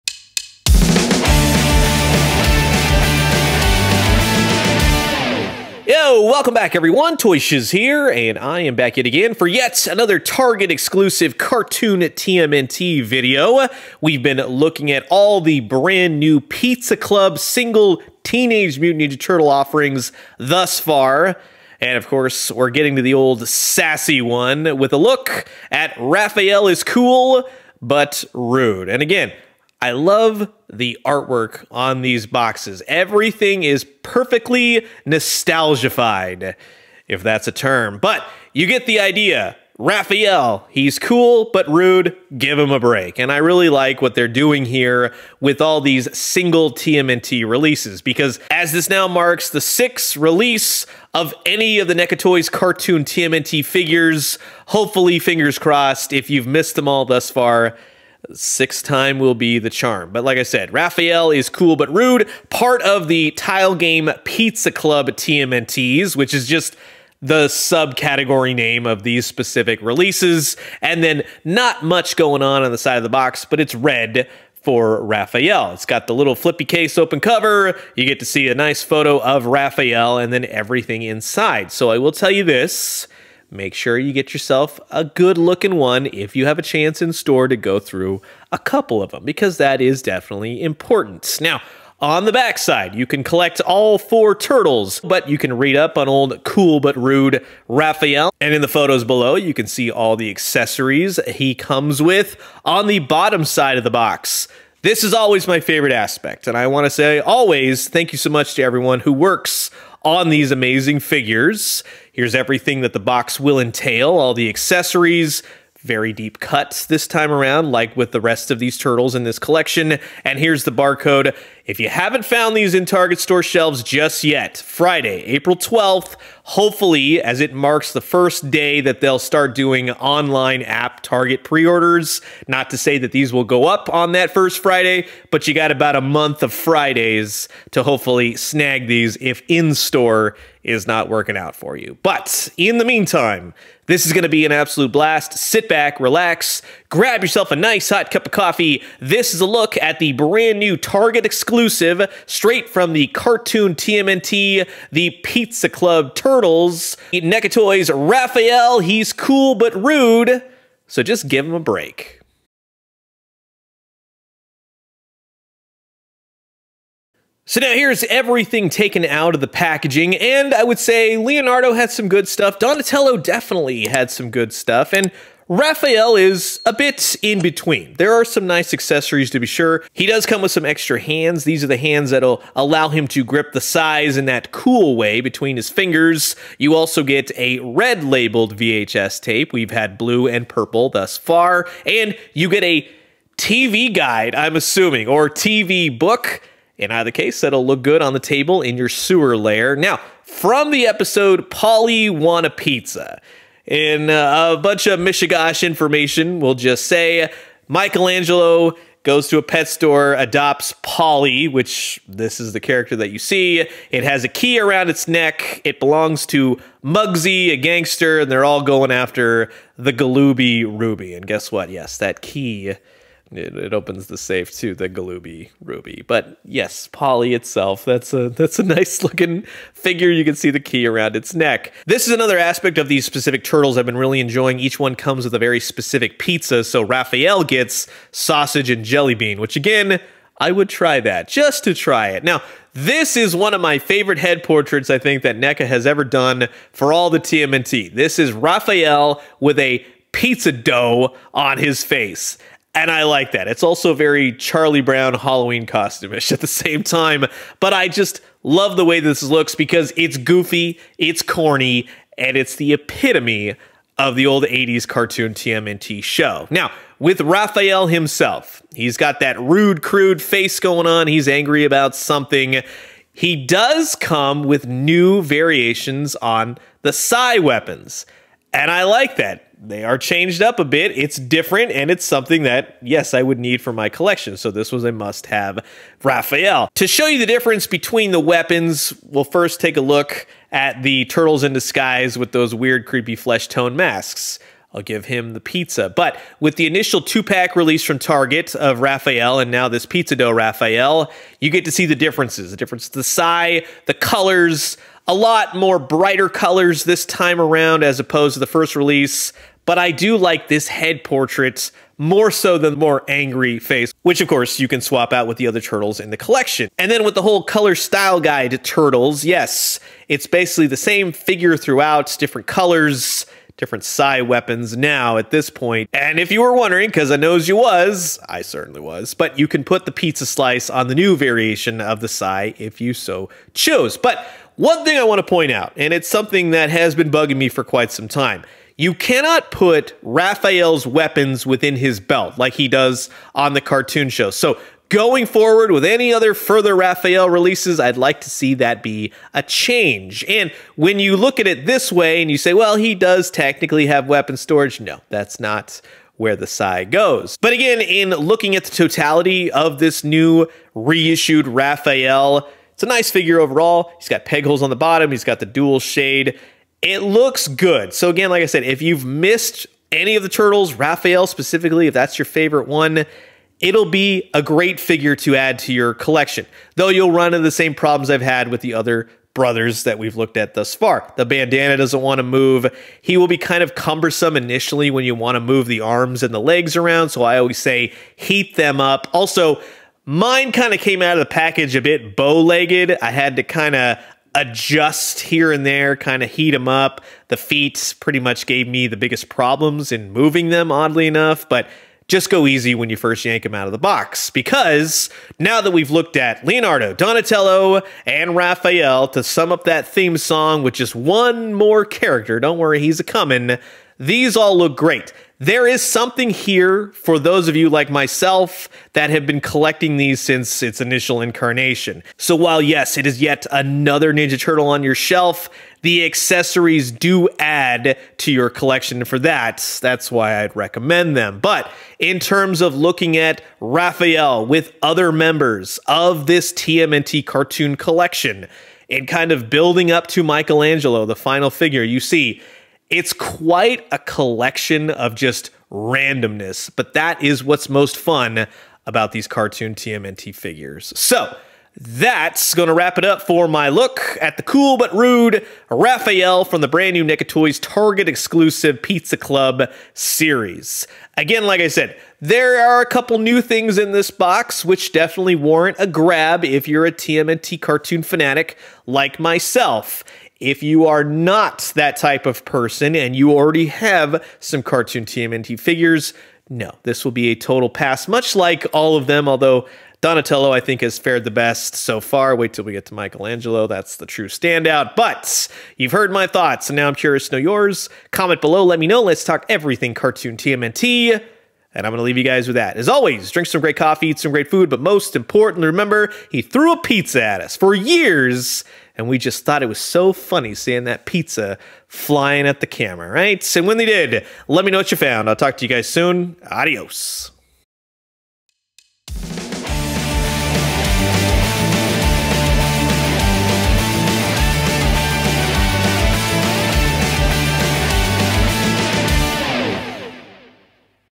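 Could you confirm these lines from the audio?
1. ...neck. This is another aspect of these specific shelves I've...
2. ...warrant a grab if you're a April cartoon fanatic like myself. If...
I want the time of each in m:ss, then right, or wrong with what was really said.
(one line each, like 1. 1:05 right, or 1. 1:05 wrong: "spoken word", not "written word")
1. 3:51 wrong: "turtles", not "shelves"
2. 7:45 wrong: "TMNT", not "April".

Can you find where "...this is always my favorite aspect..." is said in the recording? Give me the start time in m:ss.
1:44.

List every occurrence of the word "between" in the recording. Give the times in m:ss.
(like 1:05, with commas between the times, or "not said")
2:57, 3:05, 4:47.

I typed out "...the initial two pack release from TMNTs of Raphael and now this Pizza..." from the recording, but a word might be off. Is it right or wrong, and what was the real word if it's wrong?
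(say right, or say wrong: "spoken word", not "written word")
wrong: "Target", not "TMNTs".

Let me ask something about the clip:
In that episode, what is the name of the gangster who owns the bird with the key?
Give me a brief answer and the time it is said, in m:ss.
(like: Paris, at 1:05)
Mugsy, at 3:36.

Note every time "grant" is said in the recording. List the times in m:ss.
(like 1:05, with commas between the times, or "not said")
not said.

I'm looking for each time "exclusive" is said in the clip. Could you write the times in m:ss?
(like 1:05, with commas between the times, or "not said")
0:10, 2:31, 7:38.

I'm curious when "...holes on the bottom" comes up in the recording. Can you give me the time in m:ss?
6:04.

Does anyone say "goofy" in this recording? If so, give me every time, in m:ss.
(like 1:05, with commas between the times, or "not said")
4:20.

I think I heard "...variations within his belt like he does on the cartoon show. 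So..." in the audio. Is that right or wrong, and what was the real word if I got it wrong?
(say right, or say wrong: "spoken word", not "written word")
wrong: "weapons", not "variations".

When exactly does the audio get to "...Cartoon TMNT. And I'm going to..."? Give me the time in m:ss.
8:09.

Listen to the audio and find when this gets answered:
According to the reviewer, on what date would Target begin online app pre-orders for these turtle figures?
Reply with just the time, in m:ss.
2:04.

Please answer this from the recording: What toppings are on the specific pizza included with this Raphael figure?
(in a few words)
Sausage and jelly bean.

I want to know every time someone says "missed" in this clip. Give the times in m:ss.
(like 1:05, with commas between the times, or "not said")
0:56, 6:09.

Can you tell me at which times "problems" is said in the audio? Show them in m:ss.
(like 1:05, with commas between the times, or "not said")
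6:17, 6:39.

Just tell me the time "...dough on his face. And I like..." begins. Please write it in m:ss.
4:10.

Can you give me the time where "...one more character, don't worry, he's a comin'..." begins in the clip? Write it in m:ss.
6:50.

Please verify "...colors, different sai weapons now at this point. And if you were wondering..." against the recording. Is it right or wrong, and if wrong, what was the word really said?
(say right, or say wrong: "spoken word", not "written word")
right.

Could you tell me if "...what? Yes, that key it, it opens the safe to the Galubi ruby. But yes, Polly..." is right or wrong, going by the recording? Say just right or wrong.
right.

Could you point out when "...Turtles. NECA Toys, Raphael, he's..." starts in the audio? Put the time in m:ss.
2:36.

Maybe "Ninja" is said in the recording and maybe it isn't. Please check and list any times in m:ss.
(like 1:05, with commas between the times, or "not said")
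0:19, 7:04.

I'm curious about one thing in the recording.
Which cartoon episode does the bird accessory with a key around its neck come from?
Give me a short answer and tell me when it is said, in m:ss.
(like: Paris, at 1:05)
Polly Wanna Pizza, at 3:21.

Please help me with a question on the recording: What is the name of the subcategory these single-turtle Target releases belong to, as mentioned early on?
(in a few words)
Tile Game Pizza Club.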